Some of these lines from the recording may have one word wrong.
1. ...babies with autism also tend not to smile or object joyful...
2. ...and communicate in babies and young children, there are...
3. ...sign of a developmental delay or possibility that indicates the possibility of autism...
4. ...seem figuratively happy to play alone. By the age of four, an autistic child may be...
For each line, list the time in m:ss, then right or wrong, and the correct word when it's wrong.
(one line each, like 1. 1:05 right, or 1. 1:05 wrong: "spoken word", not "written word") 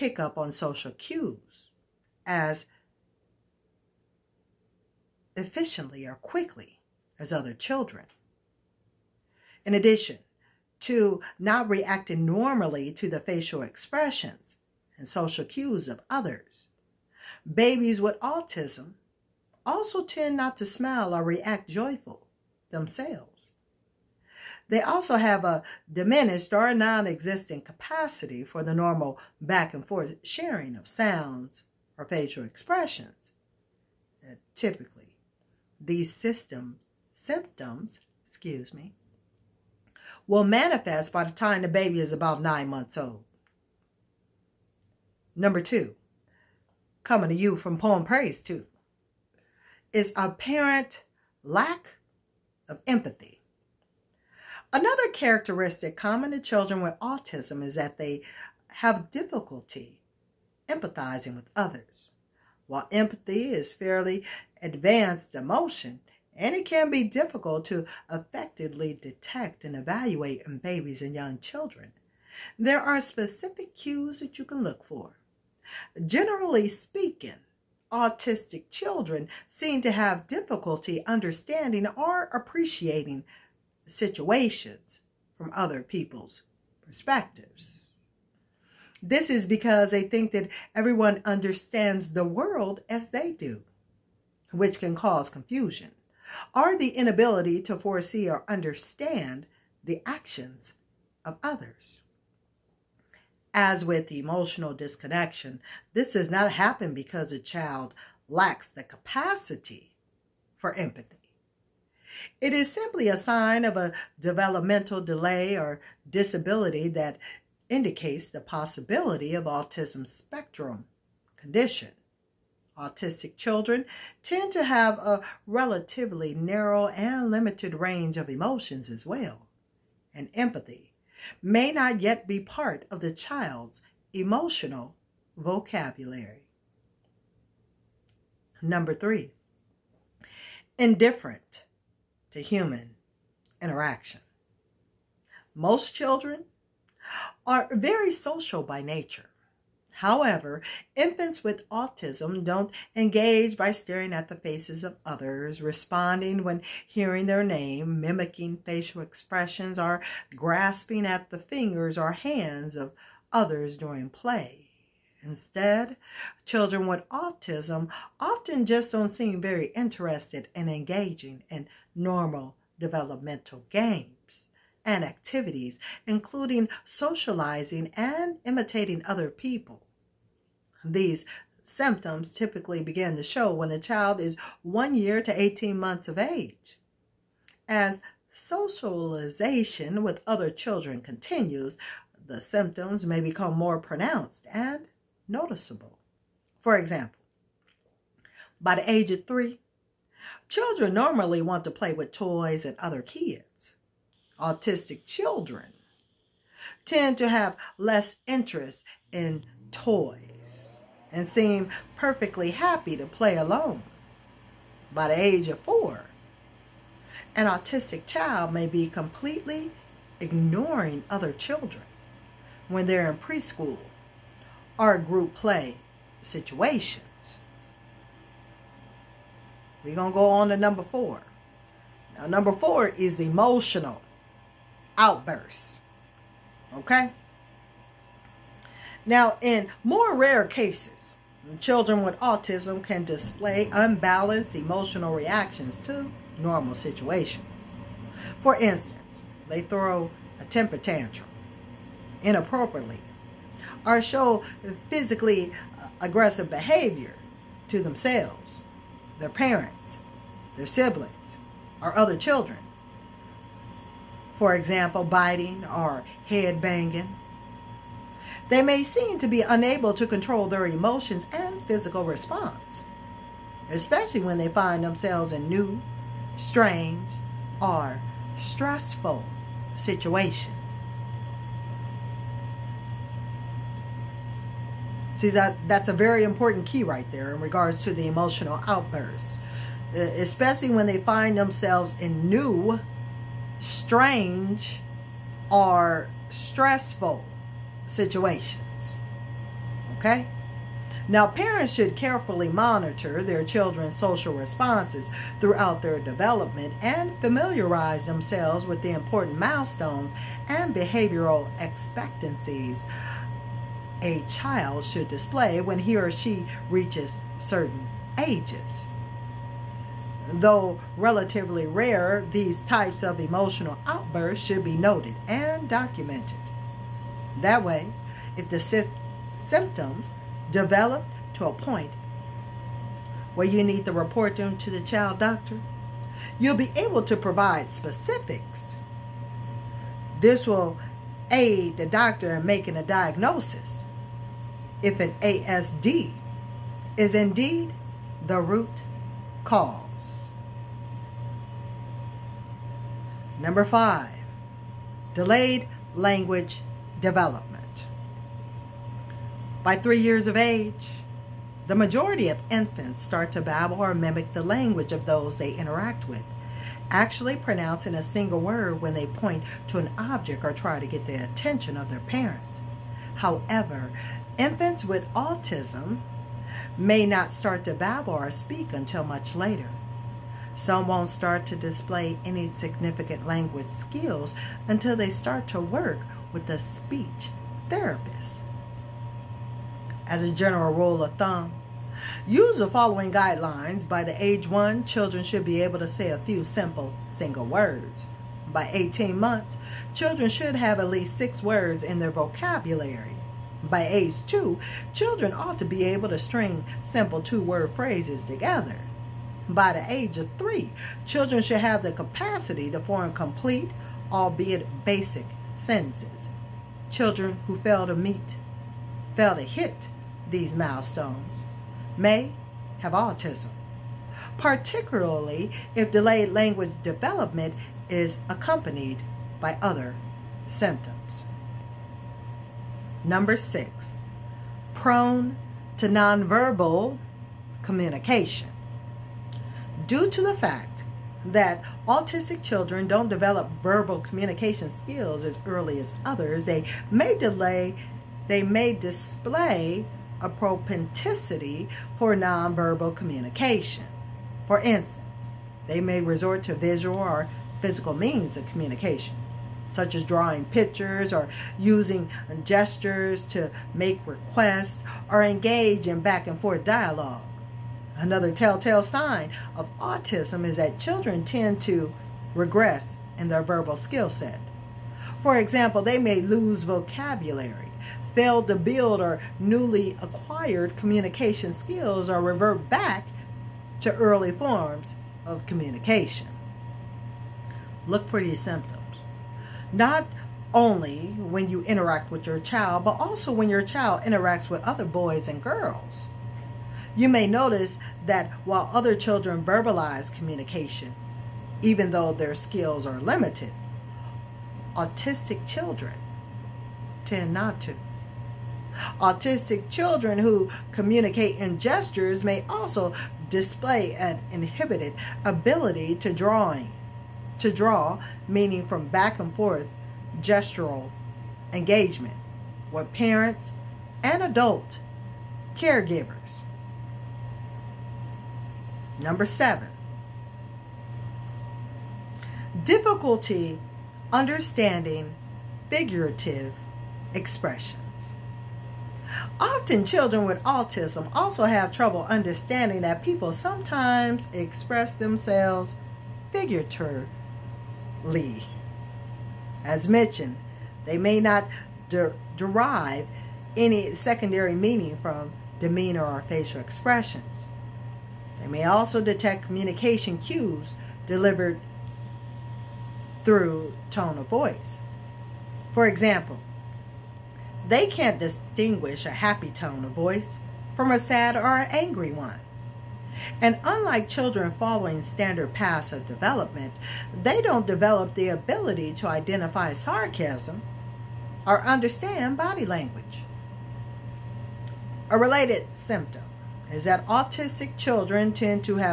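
1. 0:17 wrong: "react", not "object"
2. 1:09 wrong: "evaluate", not "communicate"
3. 1:53 wrong: "disability", not "possibility"
4. 3:31 wrong: "perfectly", not "figuratively".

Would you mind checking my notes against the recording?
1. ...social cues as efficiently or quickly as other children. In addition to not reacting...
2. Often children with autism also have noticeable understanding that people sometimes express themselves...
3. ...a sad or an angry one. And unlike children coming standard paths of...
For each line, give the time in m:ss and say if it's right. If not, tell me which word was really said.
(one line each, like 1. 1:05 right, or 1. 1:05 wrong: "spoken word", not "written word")
1. 0:00 right
2. 8:59 wrong: "trouble", not "noticeable"
3. 9:30 wrong: "following", not "coming".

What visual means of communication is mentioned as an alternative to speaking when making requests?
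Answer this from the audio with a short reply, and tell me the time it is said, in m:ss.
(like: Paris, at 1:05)
Drawing pictures, at 7:40.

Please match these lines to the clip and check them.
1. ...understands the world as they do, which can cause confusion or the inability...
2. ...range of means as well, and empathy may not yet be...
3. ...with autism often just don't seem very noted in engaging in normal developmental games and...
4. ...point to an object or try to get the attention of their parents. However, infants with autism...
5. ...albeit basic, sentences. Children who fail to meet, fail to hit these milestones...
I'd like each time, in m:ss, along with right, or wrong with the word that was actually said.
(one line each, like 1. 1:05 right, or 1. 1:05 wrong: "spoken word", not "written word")
1. 1:31 right
2. 2:07 wrong: "emotions", not "means"
3. 2:46 wrong: "interested", not "noted"
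4. 6:09 right
5. 6:54 right.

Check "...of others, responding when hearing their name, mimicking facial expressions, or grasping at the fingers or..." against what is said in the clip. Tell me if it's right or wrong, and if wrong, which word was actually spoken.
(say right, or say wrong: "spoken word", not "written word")
right.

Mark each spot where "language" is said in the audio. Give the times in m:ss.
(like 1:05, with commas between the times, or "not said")
5:55, 6:04, 6:23, 7:06, 9:42.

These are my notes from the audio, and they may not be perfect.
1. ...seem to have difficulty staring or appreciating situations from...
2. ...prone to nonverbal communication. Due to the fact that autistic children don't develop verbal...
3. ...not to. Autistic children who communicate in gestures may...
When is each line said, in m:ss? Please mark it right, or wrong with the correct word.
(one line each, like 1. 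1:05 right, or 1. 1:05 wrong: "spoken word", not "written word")
1. 1:19 wrong: "understanding", not "staring"
2. 7:14 right
3. 8:27 right.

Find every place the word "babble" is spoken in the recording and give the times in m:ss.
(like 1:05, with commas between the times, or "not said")
6:03, 6:17.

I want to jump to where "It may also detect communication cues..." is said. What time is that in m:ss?
9:18.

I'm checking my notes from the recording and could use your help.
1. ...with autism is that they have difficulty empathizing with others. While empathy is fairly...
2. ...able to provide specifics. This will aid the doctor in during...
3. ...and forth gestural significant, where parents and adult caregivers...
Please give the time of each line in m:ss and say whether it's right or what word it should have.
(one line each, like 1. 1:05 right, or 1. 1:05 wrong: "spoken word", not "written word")
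1. 0:56 right
2. 5:36 wrong: "making", not "during"
3. 8:39 wrong: "engagement", not "significant".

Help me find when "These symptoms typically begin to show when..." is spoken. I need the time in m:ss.
3:00.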